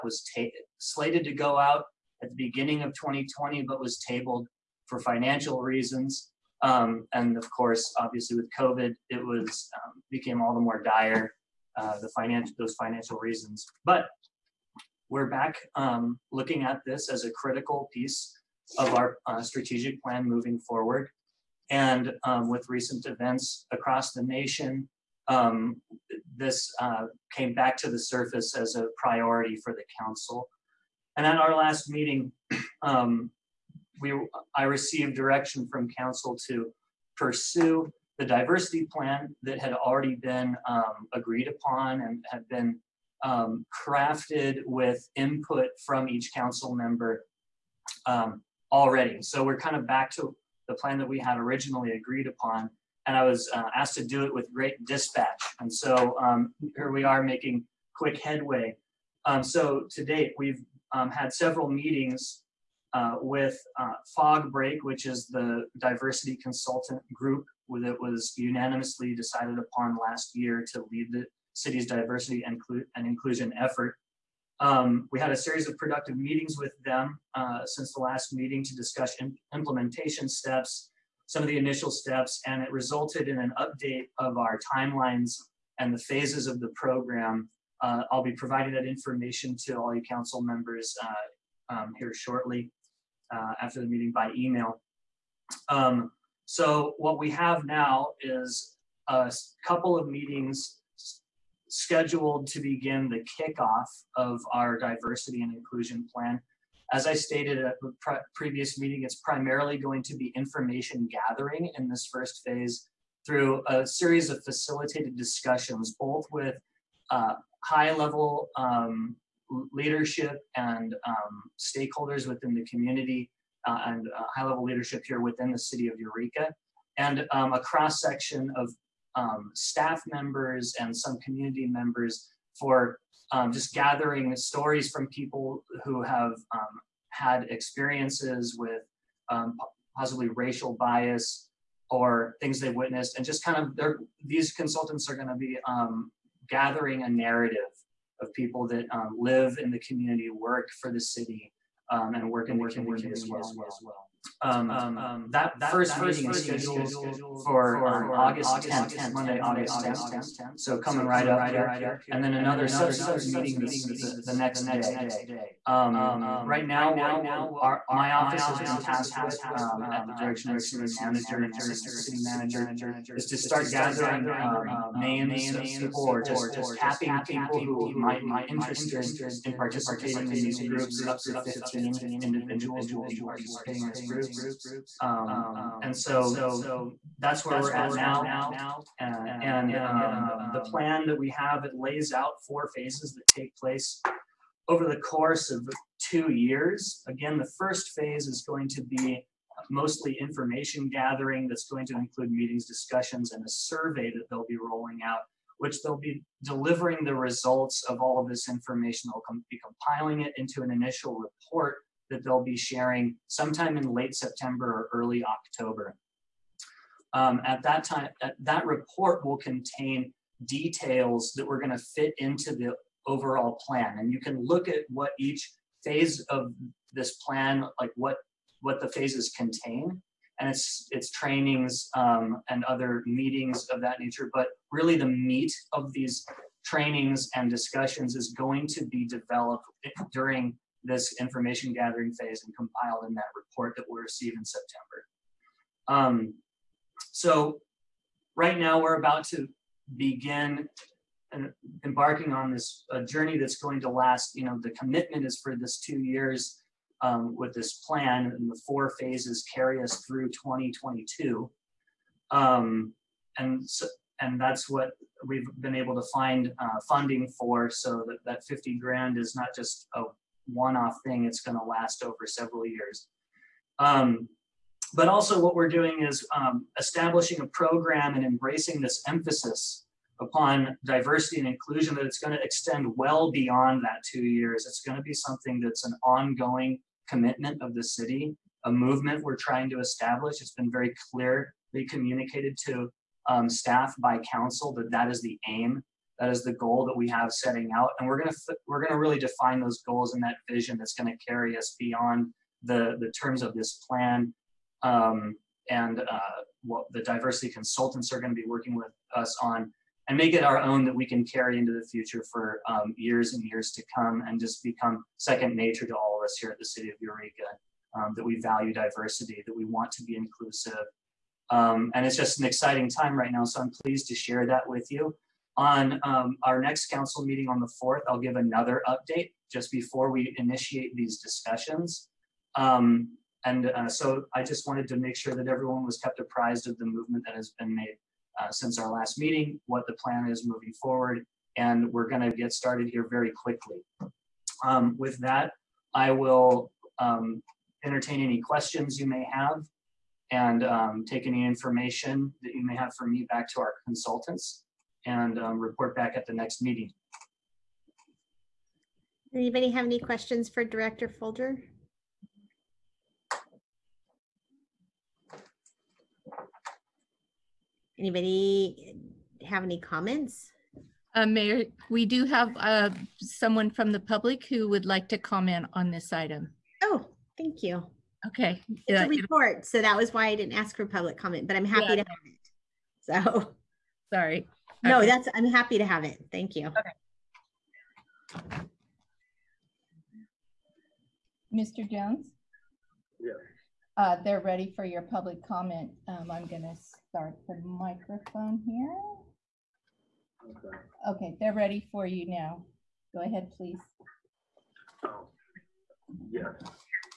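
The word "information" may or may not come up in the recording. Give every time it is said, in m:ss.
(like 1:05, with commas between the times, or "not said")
1:28, 1:50, 3:20, 3:28, 4:01, 5:51.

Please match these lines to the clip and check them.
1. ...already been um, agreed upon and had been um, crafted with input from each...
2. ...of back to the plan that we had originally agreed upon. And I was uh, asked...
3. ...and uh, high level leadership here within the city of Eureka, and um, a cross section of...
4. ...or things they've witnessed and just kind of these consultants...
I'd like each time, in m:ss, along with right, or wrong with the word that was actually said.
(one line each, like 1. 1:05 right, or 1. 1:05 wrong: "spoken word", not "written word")
1. 0:39 right
2. 0:49 right
3. 2:03 right
4. 2:21 right.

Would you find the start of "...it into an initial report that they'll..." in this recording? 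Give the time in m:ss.
3:30.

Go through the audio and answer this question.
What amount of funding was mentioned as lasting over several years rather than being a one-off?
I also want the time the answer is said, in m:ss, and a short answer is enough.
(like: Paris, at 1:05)
$50,000, at 4:28.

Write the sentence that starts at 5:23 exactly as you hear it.
So I'm pleased to share that with you.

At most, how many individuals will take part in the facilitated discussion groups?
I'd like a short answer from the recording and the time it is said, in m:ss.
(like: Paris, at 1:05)
15, at 3:01.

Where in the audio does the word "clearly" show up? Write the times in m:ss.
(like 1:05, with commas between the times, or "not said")
4:51.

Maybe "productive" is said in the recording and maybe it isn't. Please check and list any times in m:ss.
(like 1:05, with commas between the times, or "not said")
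1:15.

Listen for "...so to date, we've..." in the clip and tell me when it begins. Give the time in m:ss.
0:59.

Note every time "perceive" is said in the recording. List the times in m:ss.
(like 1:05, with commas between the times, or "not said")
not said.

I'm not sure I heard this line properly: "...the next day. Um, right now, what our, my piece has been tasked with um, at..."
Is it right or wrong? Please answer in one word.
wrong.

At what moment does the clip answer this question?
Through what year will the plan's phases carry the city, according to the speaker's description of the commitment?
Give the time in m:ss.
4:20.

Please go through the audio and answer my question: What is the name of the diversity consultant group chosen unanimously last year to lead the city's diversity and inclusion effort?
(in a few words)
Fog Break.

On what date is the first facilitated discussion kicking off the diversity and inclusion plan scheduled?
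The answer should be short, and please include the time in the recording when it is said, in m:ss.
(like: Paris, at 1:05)
Monday, August 10th, at 2:39.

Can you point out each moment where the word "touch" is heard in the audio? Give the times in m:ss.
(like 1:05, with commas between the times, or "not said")
not said.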